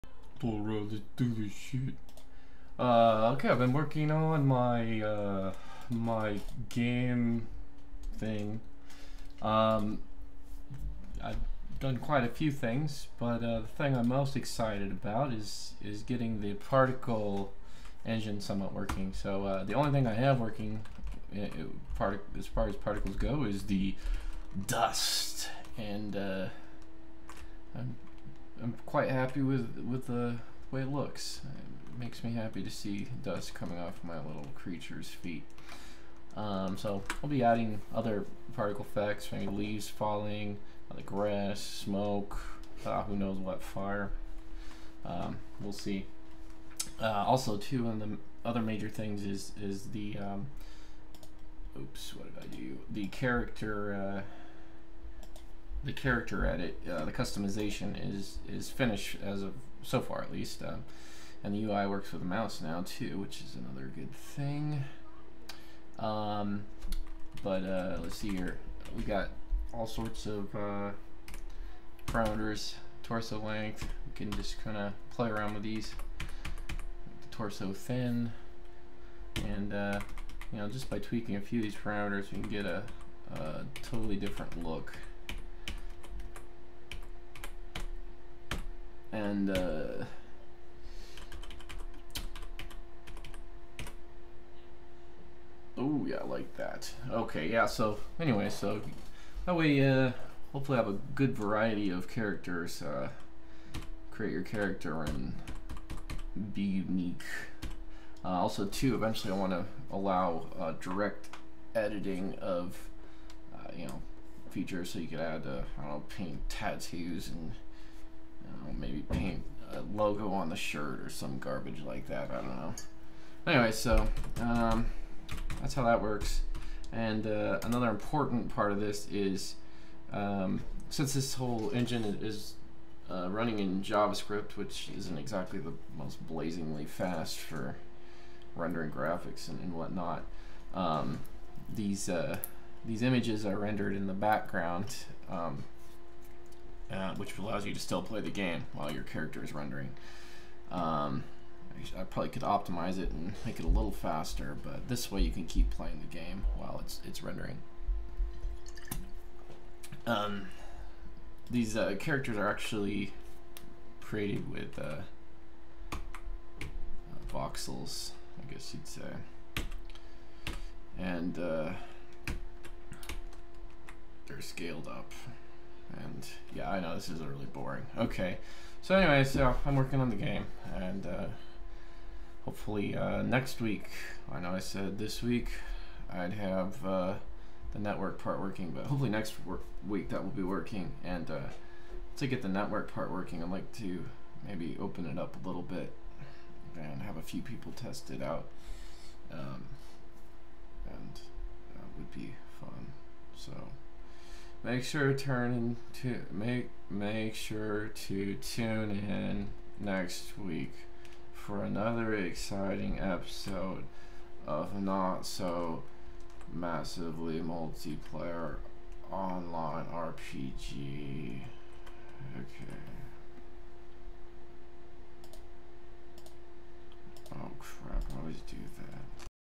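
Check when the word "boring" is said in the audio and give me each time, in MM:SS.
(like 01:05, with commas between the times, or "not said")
02:57.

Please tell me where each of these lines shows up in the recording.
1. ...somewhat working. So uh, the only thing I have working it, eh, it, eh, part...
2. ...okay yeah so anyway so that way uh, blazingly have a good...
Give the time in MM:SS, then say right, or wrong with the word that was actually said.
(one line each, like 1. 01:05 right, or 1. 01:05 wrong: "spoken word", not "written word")
1. 00:18 right
2. 01:37 wrong: "hopefully", not "blazingly".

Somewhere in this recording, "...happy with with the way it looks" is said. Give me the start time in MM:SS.
00:29.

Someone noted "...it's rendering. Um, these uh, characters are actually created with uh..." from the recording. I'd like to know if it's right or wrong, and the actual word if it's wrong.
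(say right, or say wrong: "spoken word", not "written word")
right.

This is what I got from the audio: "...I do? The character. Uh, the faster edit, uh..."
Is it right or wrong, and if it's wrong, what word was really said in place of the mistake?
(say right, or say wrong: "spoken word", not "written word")
wrong: "character", not "faster".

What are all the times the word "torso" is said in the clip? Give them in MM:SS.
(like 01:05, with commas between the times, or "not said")
01:13, 01:17.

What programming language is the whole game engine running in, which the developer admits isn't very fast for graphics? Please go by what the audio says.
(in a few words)
JavaScript.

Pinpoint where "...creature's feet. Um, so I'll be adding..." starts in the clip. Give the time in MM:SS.
00:34.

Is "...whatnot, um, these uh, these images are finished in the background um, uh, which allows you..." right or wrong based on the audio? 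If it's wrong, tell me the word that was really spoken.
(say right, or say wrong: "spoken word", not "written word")
wrong: "rendered", not "finished".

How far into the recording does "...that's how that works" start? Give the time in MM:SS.
02:05.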